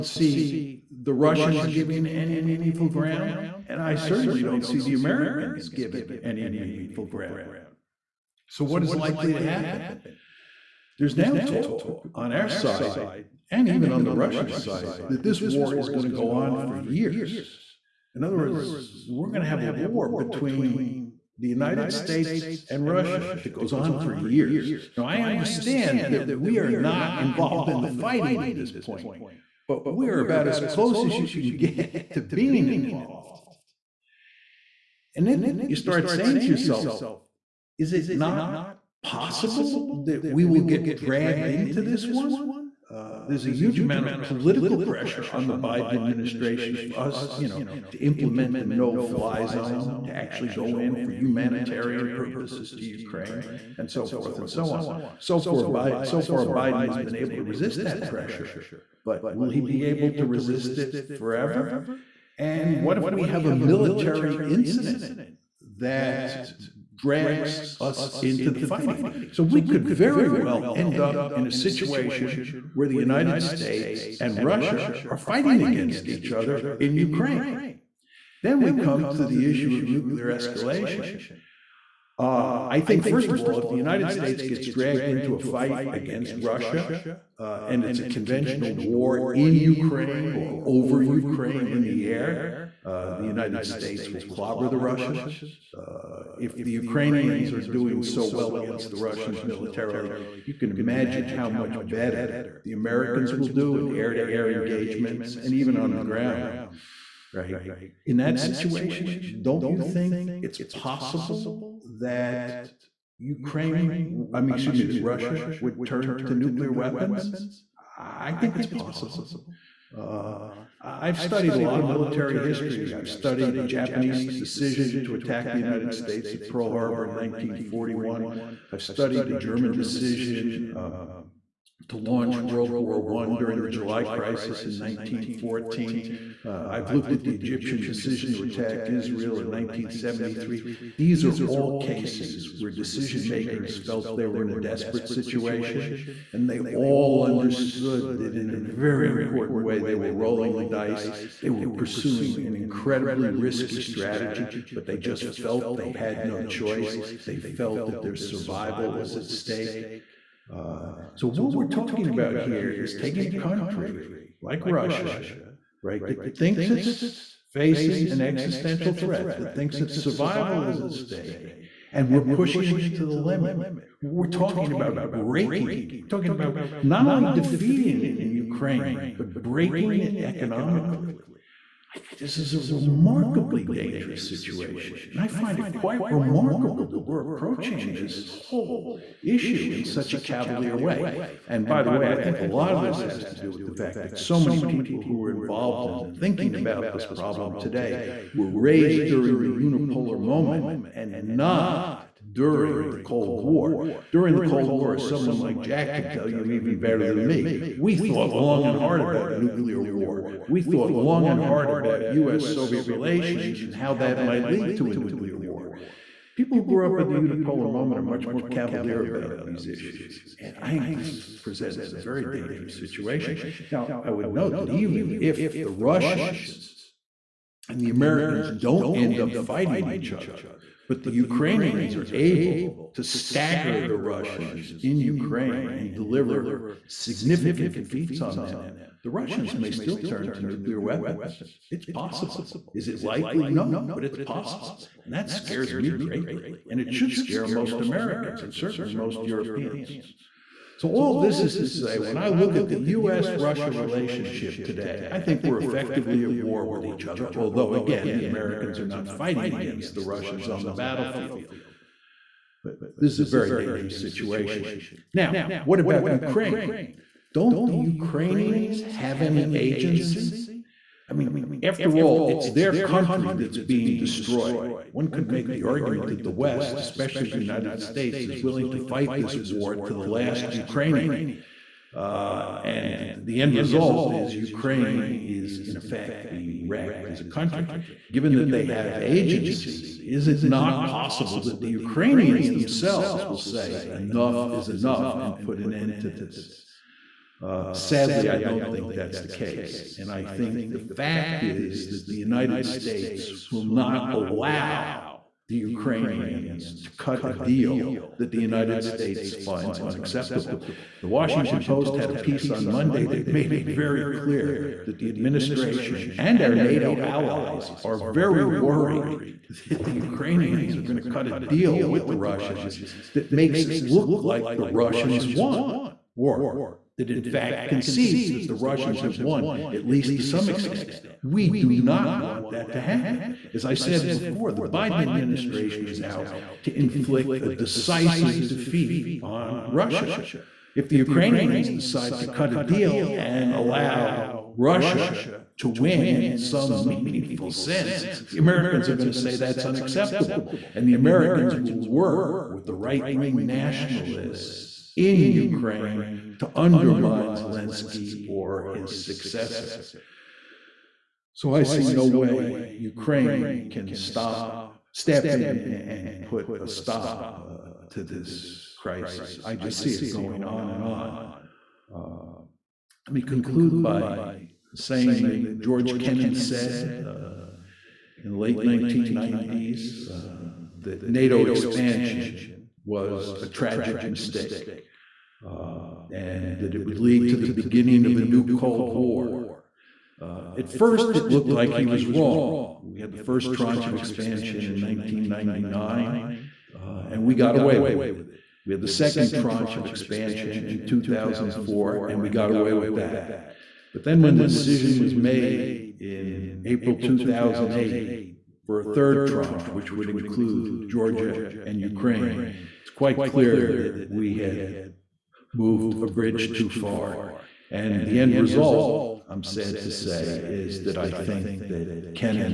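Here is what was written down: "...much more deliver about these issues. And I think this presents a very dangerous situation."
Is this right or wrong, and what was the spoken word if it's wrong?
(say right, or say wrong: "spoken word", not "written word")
wrong: "cavalier", not "deliver".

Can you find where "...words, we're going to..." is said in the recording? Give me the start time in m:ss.
0:18.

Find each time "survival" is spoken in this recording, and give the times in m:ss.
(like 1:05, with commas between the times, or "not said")
2:38, 2:49.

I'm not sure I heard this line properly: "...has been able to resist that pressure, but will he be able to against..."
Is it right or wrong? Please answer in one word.
wrong.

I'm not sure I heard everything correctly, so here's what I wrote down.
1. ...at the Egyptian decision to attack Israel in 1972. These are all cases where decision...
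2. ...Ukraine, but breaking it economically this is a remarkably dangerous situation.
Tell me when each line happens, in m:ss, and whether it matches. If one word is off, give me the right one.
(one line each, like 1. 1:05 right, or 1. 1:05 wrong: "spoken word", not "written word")
1. 2:17 wrong: "1973", not "1972"
2. 2:58 right.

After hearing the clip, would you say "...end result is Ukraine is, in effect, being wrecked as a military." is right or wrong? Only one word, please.
wrong.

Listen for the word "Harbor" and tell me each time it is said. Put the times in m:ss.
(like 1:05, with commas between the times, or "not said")
2:06.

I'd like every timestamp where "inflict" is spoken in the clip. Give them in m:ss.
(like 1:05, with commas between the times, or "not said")
5:36.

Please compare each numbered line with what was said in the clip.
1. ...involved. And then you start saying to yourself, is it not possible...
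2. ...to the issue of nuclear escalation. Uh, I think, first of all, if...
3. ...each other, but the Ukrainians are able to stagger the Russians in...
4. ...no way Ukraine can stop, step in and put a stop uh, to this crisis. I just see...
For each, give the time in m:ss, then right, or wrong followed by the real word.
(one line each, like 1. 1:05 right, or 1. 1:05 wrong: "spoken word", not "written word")
1. 0:32 right
2. 1:19 right
3. 3:49 right
4. 6:01 right.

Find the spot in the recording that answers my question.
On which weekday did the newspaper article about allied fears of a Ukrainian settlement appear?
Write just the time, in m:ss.
5:12.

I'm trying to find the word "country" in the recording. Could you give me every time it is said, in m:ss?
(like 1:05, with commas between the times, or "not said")
2:43, 4:32, 4:47.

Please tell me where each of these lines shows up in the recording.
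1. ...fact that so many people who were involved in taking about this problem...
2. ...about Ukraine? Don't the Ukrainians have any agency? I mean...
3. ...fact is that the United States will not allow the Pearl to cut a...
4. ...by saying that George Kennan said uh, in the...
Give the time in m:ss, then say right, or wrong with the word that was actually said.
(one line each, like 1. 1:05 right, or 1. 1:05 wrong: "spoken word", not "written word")
1. 3:13 wrong: "thinking", not "taking"
2. 4:25 right
3. 5:00 wrong: "Ukrainians", not "Pearl"
4. 6:13 right.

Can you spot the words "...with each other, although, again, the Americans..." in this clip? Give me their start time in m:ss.
4:16.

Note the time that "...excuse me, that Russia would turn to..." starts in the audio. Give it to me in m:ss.
1:54.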